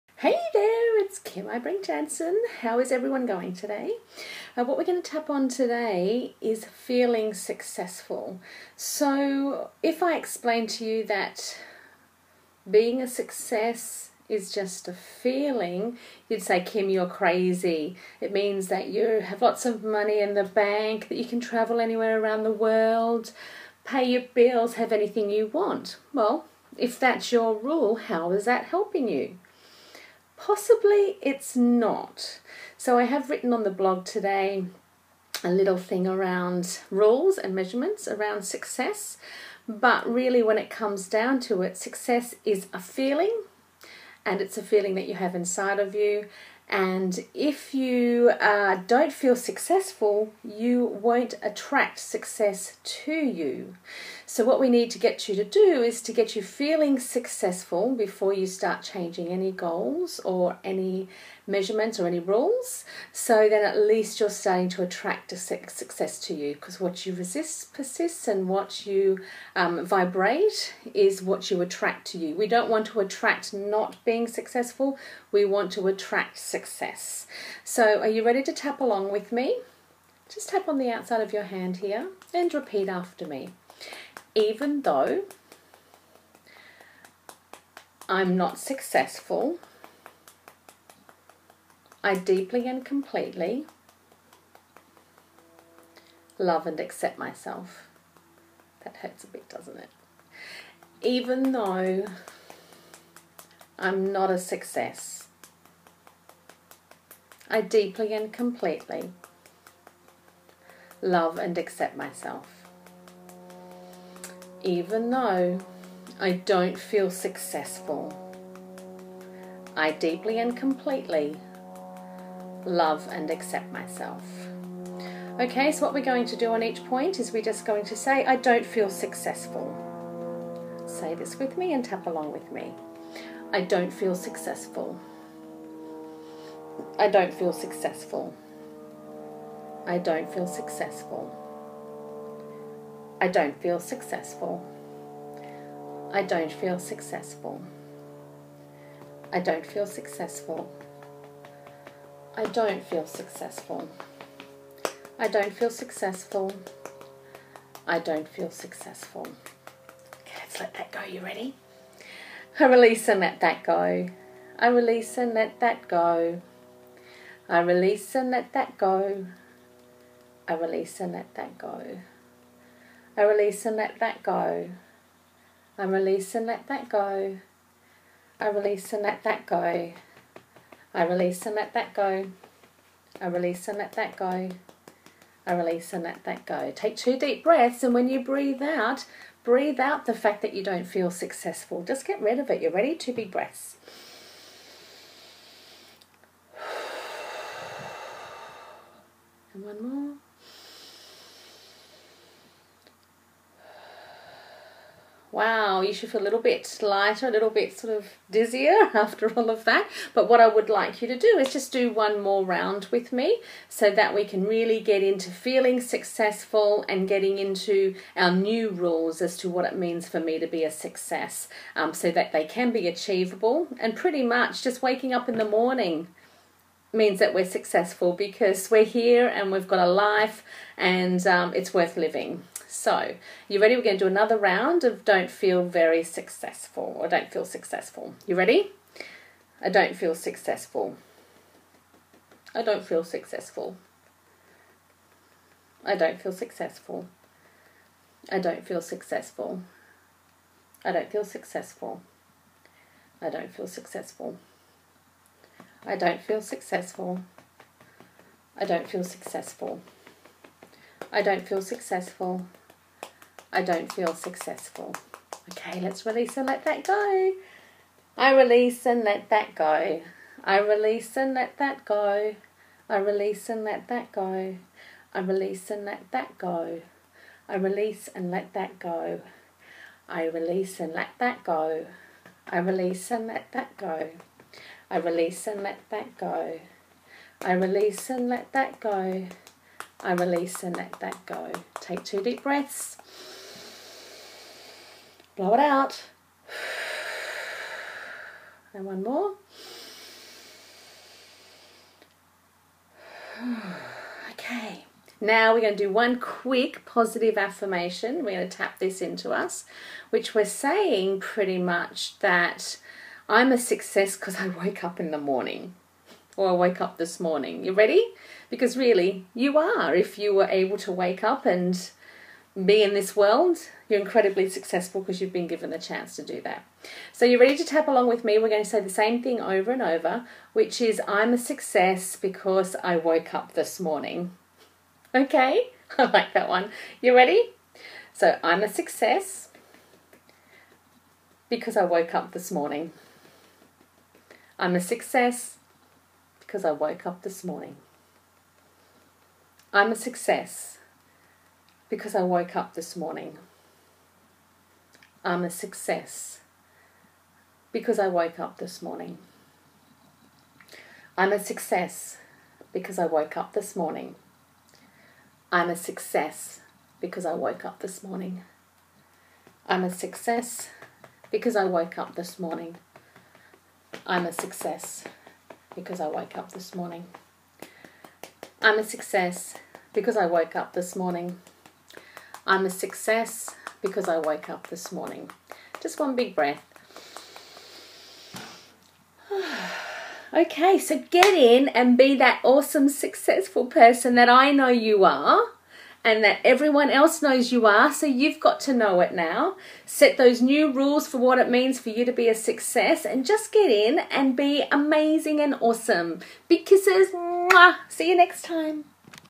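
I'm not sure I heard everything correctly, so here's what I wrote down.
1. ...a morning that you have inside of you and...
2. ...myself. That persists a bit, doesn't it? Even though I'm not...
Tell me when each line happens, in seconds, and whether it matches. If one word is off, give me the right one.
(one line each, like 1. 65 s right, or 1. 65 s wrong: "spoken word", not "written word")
1. 44 s wrong: "feeling", not "morning"
2. 97 s wrong: "hurts", not "persists".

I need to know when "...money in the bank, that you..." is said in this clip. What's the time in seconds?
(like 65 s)
19 s.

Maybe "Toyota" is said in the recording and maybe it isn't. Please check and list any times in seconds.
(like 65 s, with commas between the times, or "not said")
not said.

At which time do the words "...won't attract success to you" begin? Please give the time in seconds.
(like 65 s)
50 s.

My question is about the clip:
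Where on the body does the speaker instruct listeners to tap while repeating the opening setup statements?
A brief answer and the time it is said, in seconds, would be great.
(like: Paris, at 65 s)
Outside of your hand, at 80 s.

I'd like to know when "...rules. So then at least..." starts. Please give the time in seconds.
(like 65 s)
62 s.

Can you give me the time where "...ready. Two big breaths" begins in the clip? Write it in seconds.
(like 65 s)
192 s.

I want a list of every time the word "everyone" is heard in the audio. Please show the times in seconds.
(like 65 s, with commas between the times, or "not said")
2 s, 396 s.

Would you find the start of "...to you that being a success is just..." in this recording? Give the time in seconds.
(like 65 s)
10 s.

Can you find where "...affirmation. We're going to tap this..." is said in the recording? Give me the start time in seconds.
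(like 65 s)
307 s.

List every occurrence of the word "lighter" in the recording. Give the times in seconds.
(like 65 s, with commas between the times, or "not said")
206 s.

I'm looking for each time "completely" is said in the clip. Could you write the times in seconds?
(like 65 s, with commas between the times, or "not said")
92 s, 108 s, 120 s.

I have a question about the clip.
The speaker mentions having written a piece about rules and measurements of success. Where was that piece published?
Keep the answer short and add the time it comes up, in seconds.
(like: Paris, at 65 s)
The blog, at 33 s.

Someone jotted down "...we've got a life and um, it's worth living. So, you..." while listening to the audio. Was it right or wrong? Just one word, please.
right.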